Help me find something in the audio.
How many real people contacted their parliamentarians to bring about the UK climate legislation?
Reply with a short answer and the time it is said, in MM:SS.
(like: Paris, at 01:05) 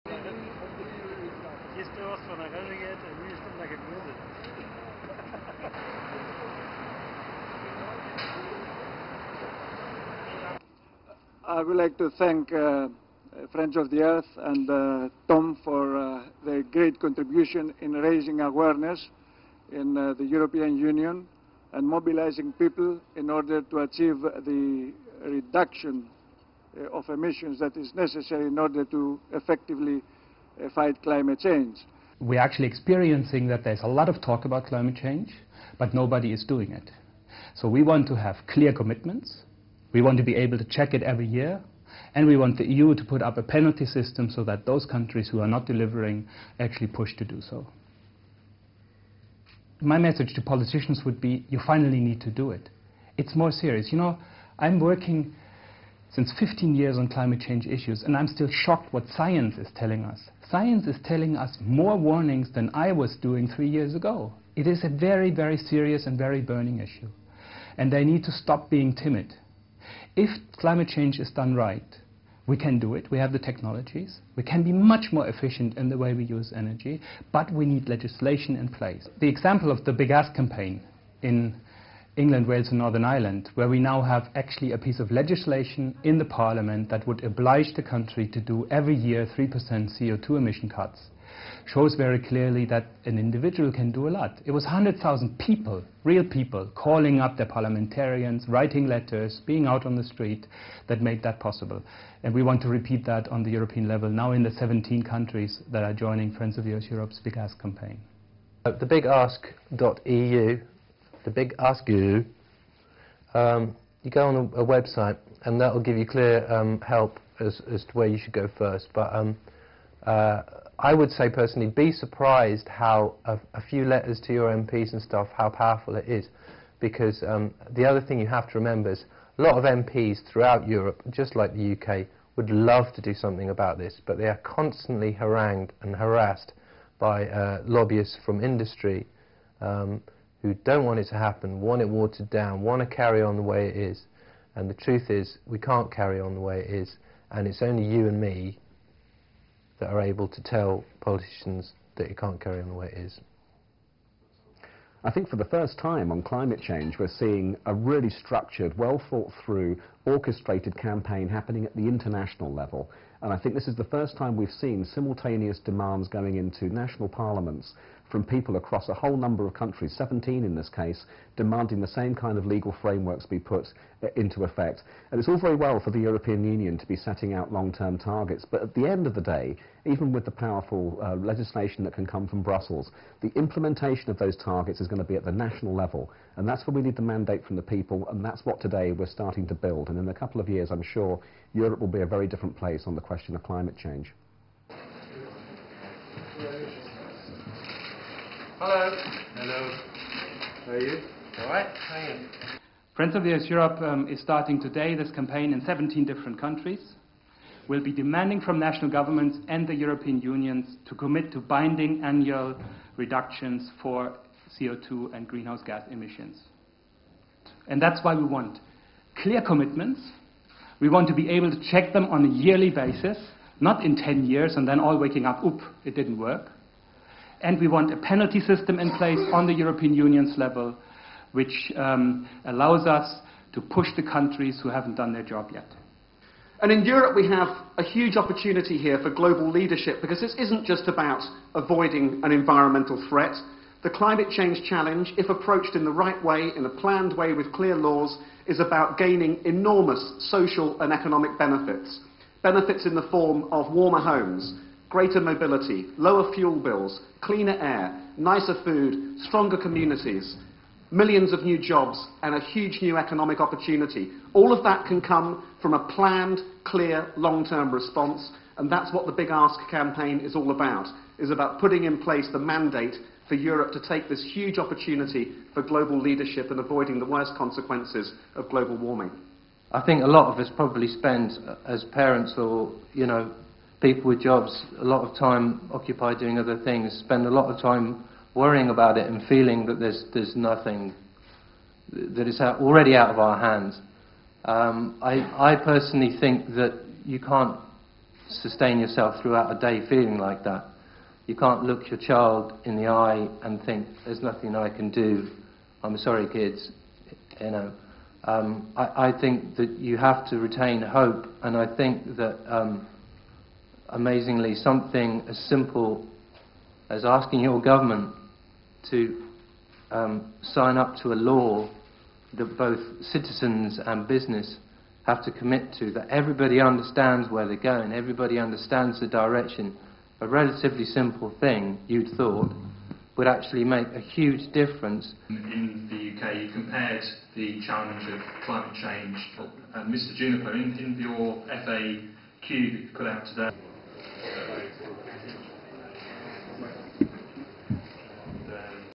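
100,000, at 01:34.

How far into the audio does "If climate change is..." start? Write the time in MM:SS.
01:10.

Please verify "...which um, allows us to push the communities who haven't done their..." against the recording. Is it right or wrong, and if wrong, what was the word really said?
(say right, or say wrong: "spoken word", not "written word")
wrong: "countries", not "communities".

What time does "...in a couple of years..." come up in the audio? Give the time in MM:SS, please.
03:09.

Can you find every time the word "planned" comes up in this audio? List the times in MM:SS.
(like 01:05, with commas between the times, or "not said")
04:06, 04:25.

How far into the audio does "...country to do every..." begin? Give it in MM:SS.
01:27.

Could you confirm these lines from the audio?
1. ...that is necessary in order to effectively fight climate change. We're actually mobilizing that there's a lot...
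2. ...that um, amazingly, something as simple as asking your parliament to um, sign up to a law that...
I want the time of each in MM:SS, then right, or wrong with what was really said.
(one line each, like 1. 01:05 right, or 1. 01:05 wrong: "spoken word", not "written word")
1. 00:27 wrong: "experiencing", not "mobilizing"
2. 05:12 wrong: "government", not "parliament".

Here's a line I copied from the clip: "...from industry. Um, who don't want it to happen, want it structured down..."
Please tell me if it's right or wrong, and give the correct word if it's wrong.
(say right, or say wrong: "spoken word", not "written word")
wrong: "watered", not "structured".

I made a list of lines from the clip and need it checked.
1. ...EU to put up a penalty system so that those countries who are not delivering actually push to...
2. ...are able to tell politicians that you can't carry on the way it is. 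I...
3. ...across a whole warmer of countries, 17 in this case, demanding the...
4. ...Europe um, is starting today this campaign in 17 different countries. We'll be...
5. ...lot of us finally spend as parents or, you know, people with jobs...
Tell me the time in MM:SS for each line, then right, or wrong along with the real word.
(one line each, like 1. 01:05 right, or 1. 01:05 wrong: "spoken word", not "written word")
1. 00:42 right
2. 02:29 right
3. 02:48 wrong: "number", not "warmer"
4. 03:23 right
5. 04:40 wrong: "probably", not "finally".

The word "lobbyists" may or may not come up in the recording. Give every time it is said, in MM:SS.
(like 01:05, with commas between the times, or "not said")
02:17.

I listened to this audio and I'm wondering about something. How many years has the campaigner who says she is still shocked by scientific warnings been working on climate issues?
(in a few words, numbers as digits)
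15.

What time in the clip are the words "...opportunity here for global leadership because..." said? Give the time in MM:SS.
03:58.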